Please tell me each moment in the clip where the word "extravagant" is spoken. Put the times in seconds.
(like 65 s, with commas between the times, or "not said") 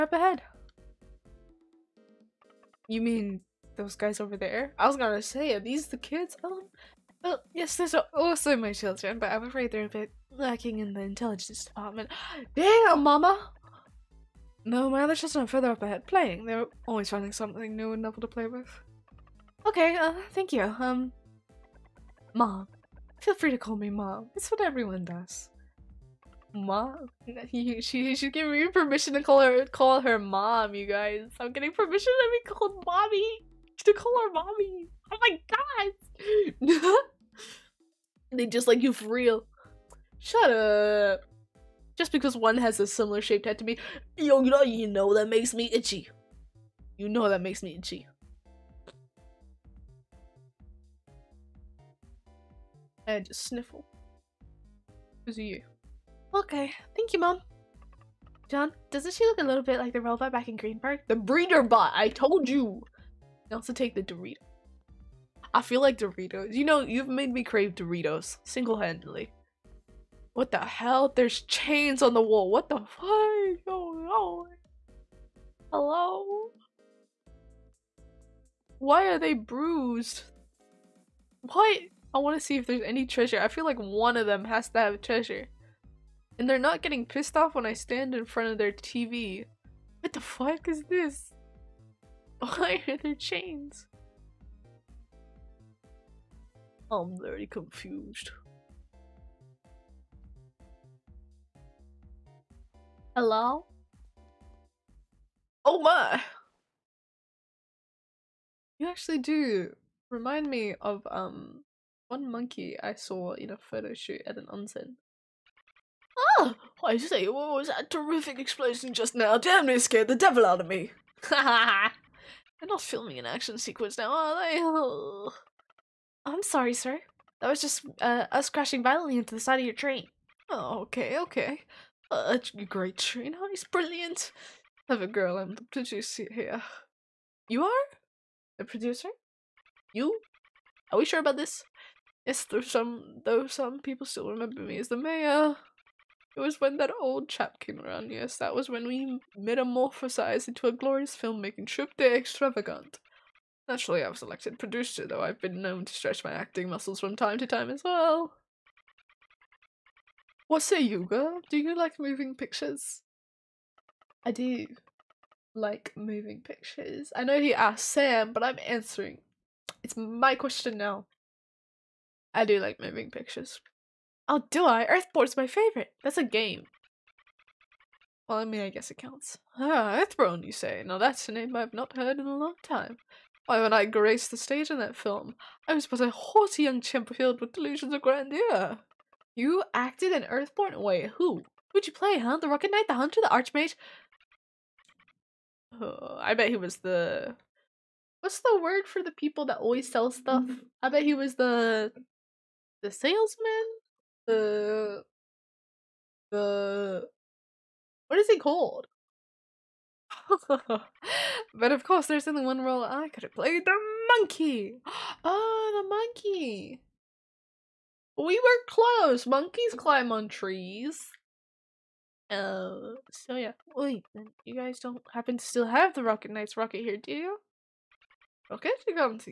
152 s.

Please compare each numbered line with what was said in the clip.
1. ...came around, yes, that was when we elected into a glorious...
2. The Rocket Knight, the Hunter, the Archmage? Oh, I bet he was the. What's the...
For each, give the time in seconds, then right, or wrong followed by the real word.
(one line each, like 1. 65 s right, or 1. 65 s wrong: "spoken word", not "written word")
1. 147 s wrong: "metamorphosized", not "elected"
2. 192 s right.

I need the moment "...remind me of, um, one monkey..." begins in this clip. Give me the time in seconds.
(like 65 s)
110 s.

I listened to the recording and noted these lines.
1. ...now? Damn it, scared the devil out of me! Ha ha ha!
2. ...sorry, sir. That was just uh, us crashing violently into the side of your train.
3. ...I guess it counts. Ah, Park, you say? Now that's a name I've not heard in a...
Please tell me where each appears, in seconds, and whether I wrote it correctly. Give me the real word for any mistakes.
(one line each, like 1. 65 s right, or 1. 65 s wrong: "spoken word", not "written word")
1. 119 s right
2. 126 s right
3. 178 s wrong: "Earthborn", not "Park".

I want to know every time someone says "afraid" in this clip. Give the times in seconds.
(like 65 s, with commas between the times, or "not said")
9 s.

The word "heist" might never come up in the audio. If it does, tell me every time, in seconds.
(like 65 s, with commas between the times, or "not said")
133 s.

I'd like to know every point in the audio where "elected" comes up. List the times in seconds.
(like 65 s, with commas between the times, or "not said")
154 s.